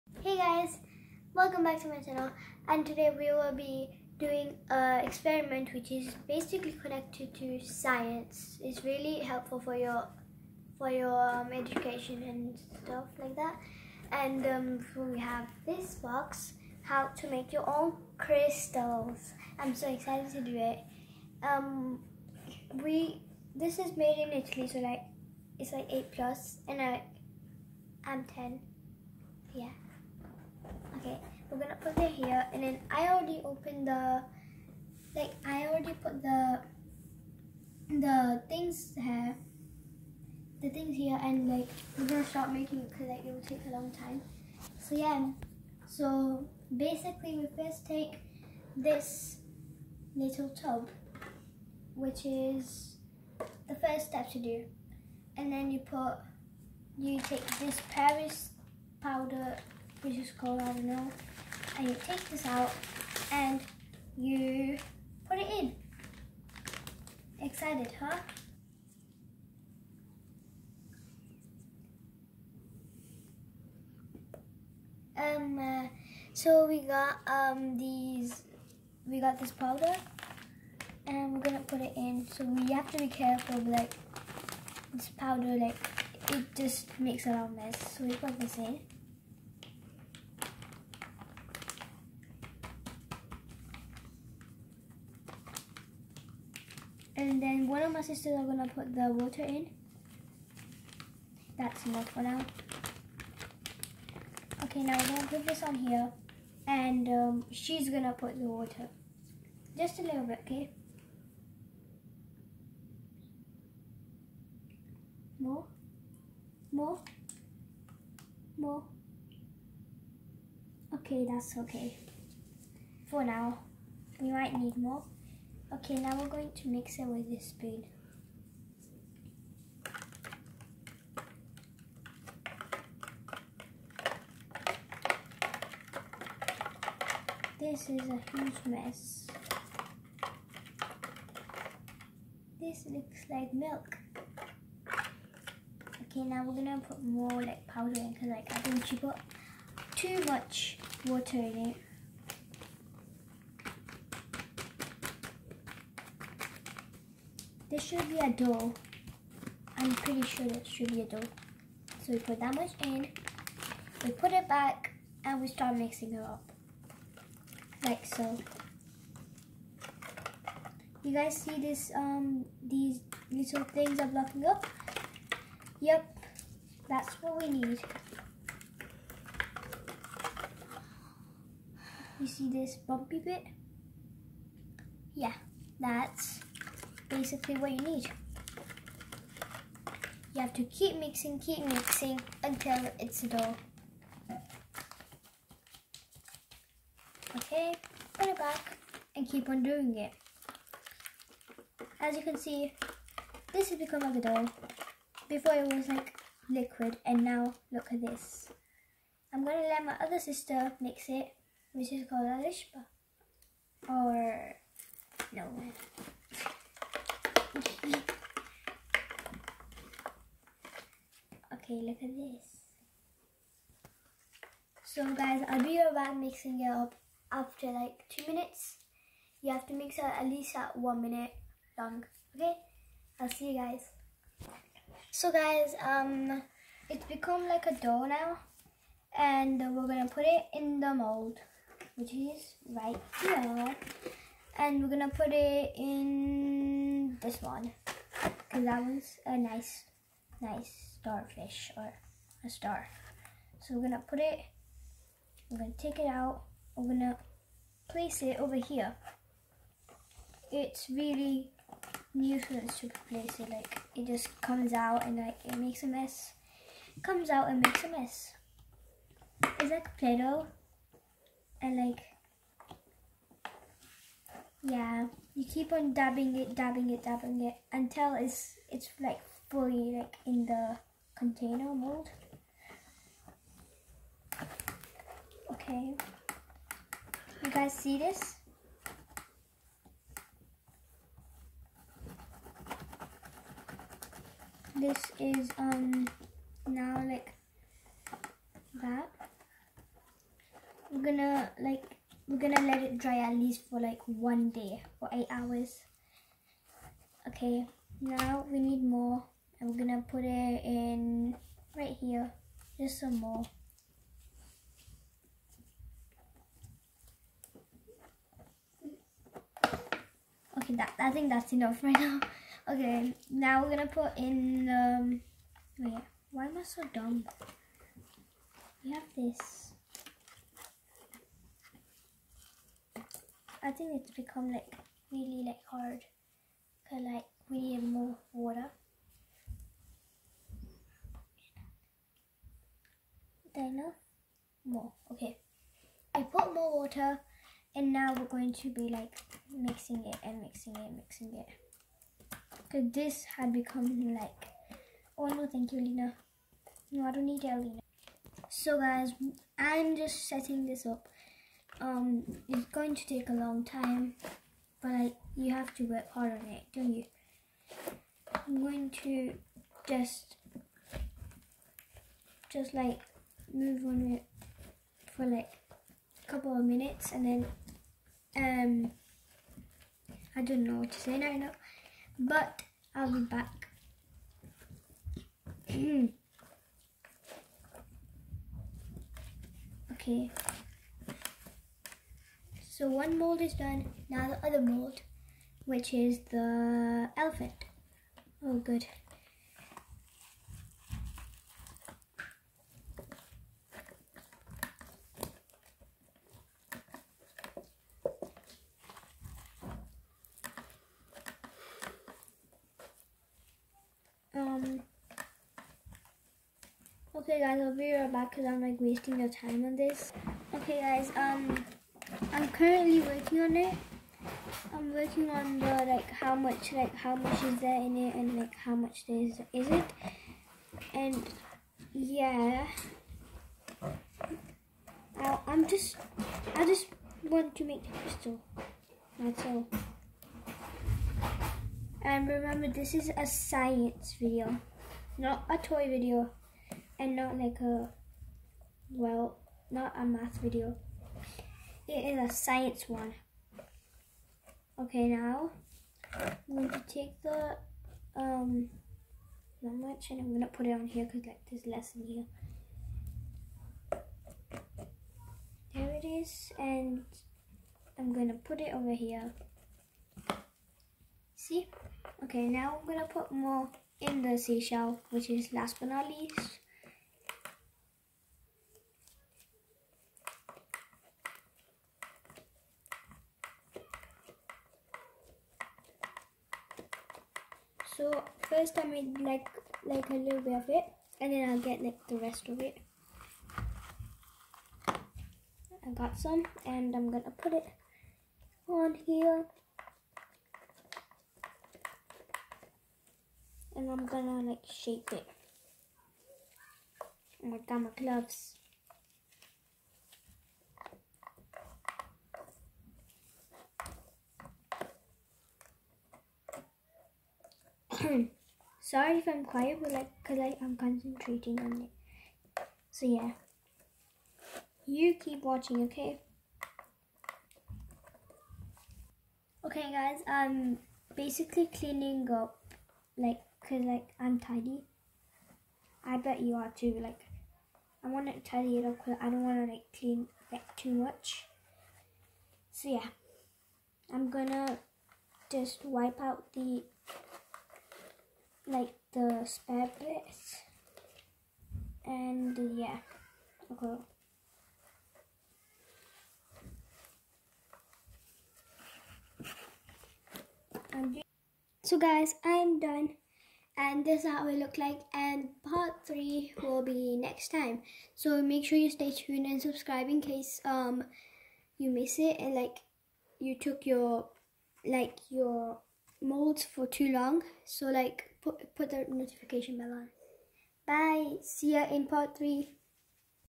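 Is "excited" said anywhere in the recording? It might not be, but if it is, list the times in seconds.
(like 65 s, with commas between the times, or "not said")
19 s, 67 s.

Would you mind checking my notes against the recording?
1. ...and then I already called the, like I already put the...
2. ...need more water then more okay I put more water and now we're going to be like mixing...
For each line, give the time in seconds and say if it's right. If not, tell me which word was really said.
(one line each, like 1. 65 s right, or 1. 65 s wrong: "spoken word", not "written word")
1. 32 s wrong: "opened", not "called"
2. 337 s right.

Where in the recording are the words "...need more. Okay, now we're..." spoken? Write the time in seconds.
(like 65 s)
124 s.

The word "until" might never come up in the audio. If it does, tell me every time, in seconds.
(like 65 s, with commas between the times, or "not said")
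192 s, 277 s.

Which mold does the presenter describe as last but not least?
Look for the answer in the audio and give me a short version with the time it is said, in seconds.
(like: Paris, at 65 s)
Seashell, at 474 s.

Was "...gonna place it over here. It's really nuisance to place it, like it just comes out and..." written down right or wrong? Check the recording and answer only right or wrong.
right.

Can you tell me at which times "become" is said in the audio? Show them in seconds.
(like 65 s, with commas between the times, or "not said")
203 s, 237 s, 334 s, 353 s.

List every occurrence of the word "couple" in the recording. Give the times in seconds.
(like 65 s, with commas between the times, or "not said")
376 s.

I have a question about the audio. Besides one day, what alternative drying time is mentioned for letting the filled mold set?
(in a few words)
8 hours.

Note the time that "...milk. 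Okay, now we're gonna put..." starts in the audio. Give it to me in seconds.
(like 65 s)
143 s.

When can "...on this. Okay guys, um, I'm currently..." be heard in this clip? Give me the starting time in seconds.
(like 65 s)
419 s.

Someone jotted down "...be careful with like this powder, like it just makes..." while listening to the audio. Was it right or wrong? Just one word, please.
right.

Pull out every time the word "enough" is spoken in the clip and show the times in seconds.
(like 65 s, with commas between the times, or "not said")
101 s, 321 s.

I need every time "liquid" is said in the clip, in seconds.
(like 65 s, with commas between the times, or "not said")
206 s.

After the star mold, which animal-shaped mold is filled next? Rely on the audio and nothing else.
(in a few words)
Elephant.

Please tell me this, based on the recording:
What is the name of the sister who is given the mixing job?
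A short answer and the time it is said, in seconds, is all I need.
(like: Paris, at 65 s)
Lishba, at 212 s.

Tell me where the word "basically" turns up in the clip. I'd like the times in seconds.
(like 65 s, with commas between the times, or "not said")
6 s, 46 s, 187 s, 531 s.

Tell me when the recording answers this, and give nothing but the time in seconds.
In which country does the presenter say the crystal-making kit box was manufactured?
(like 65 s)
24 s.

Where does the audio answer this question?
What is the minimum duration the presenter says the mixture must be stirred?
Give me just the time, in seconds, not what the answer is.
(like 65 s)
230 s.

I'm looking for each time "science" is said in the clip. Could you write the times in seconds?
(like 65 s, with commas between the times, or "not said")
7 s, 443 s, 452 s.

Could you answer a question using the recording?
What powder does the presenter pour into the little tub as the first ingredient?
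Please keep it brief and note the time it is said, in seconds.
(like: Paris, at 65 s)
Paris powder, at 57 s.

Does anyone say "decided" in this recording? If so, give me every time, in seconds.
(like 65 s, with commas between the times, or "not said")
not said.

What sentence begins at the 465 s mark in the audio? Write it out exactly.
There it is and I'm gonna put it over here.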